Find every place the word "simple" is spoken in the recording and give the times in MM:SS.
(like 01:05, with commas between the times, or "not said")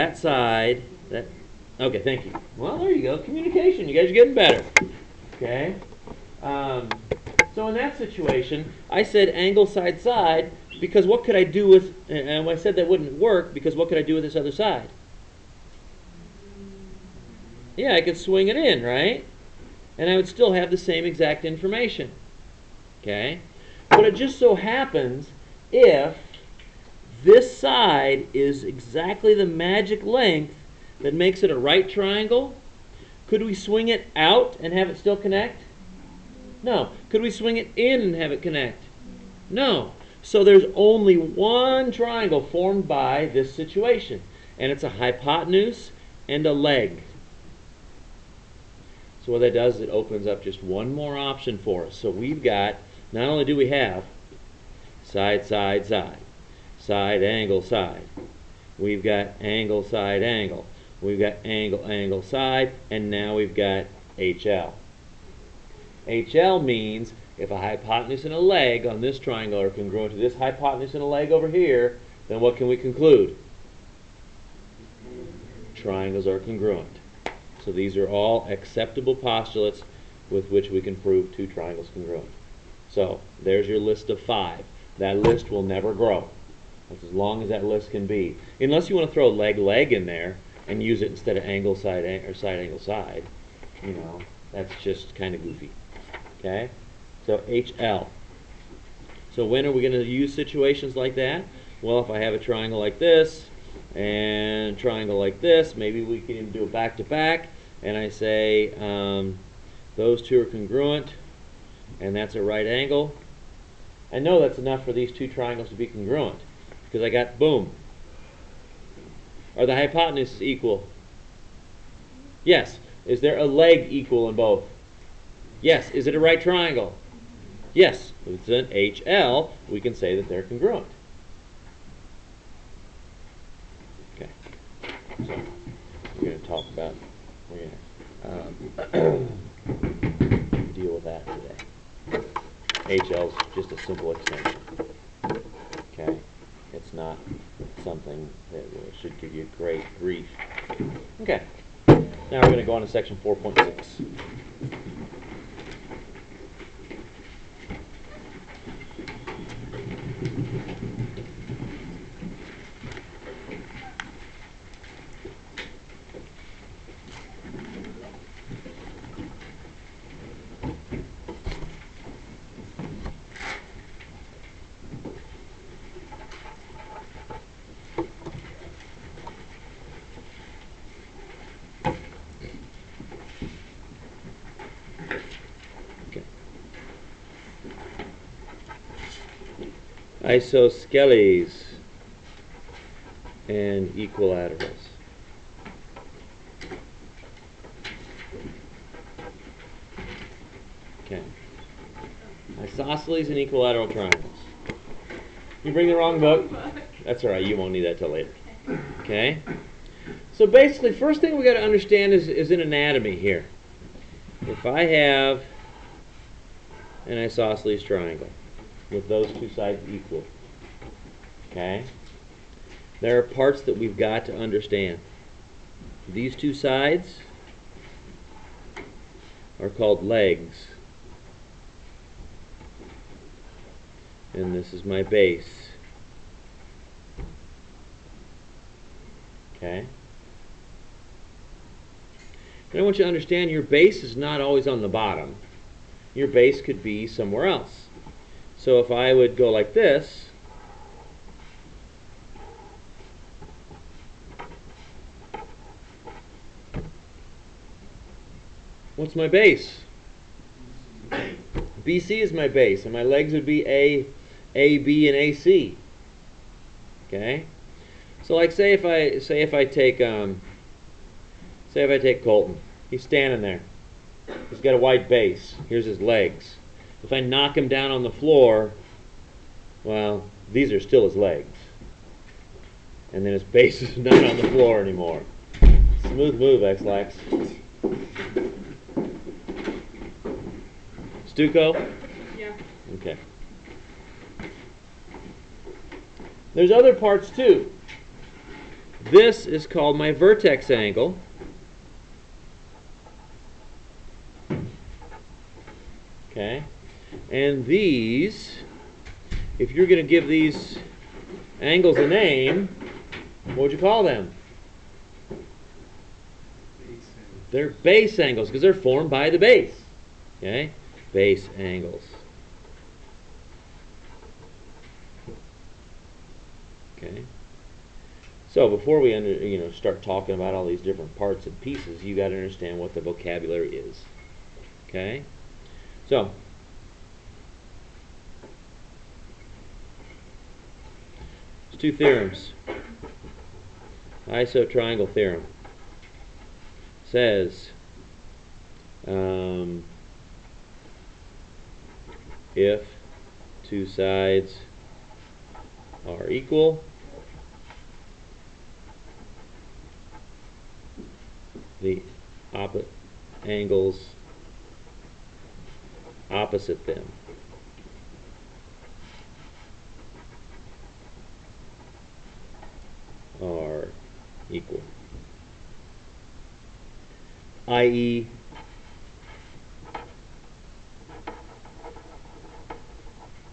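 02:23.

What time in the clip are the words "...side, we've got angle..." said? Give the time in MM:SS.
00:57.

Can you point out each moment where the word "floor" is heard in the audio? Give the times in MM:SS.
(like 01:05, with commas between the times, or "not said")
04:38, 04:44.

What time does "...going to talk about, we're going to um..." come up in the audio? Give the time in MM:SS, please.
02:16.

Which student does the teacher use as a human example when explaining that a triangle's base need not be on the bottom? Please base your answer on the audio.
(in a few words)
Colton.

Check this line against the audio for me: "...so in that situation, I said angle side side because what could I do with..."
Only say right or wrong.
right.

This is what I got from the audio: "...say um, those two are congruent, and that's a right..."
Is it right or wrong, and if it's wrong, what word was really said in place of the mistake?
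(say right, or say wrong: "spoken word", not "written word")
right.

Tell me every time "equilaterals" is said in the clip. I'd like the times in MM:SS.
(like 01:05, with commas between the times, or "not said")
03:13, 03:23.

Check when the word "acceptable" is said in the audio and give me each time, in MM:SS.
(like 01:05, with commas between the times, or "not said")
01:18.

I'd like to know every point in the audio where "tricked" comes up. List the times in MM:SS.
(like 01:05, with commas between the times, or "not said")
not said.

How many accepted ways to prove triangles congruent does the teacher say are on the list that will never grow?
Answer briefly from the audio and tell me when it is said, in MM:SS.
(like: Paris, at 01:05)
5, at 01:24.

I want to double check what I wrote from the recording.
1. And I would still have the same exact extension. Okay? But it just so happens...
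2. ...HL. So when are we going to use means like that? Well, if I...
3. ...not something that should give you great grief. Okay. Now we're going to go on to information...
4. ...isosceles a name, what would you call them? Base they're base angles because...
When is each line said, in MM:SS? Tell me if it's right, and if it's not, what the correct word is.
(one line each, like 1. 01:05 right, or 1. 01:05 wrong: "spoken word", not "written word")
1. 00:19 wrong: "information", not "extension"
2. 01:37 wrong: "situations", not "means"
3. 02:26 wrong: "section", not "information"
4. 05:11 wrong: "angles", not "isosceles".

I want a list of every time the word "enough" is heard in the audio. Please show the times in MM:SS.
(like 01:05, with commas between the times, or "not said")
01:54.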